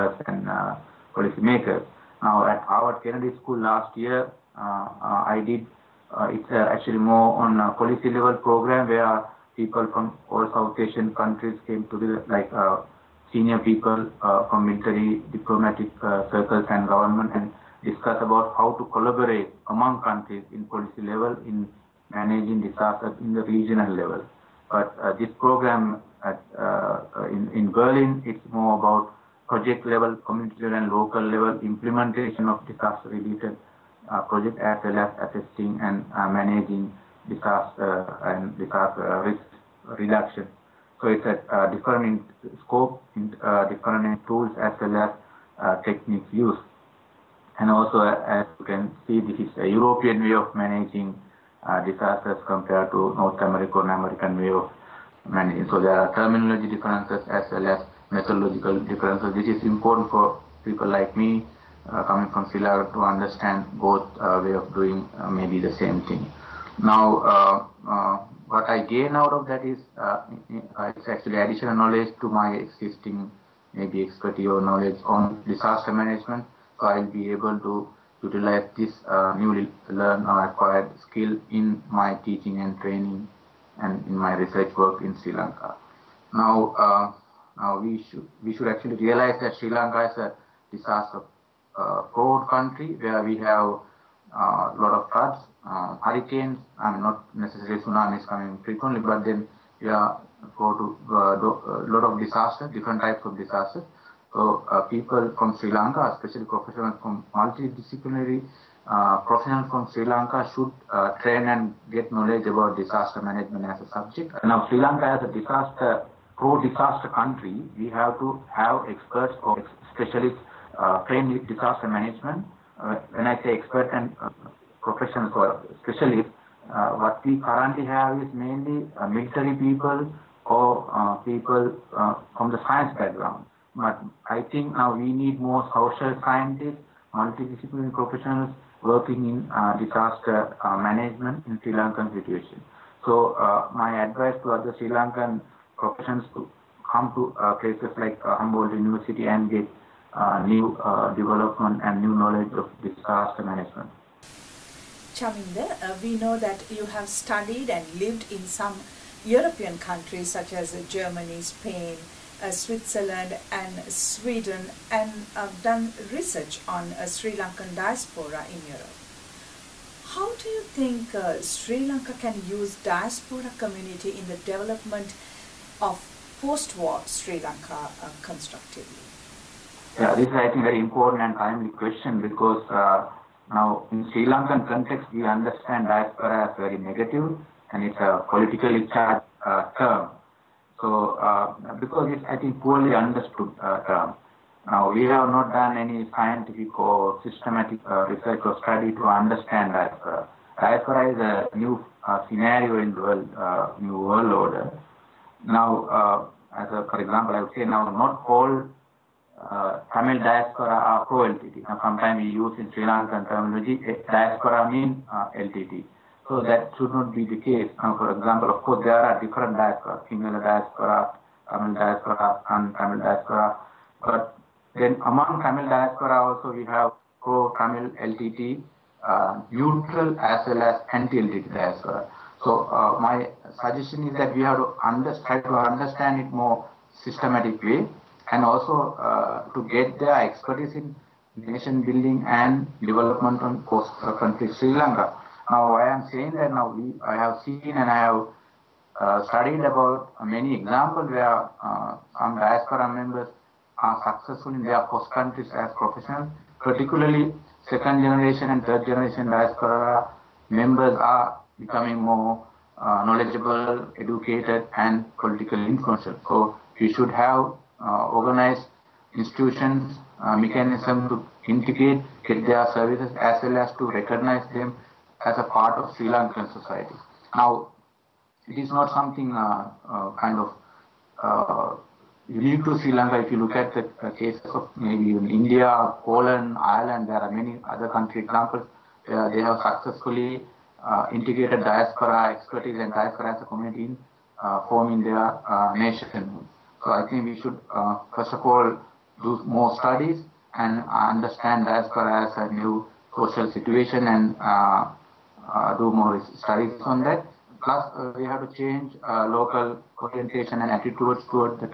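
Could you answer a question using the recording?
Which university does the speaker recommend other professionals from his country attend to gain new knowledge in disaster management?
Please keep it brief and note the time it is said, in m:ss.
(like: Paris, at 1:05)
Humboldt University, at 2:28.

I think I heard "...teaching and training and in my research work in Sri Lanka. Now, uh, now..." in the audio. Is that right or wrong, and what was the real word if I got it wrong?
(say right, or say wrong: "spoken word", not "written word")
right.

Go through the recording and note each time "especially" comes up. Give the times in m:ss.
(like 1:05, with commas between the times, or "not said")
1:46, 2:05.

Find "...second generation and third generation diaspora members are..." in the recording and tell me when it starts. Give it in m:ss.
4:17.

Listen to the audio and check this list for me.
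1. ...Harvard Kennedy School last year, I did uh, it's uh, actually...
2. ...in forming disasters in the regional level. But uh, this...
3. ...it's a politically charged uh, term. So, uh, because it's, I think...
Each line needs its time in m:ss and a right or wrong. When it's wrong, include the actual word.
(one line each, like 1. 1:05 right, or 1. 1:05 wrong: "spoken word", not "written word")
1. 0:02 right
2. 0:21 wrong: "managing", not "forming"
3. 3:07 right.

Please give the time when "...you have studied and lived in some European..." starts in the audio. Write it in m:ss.
2:36.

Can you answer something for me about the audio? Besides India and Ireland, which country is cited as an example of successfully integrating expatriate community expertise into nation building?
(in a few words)
Poland.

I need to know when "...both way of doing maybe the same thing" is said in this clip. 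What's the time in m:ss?
1:03.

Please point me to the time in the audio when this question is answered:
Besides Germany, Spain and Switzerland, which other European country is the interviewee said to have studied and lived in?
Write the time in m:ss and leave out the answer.
2:43.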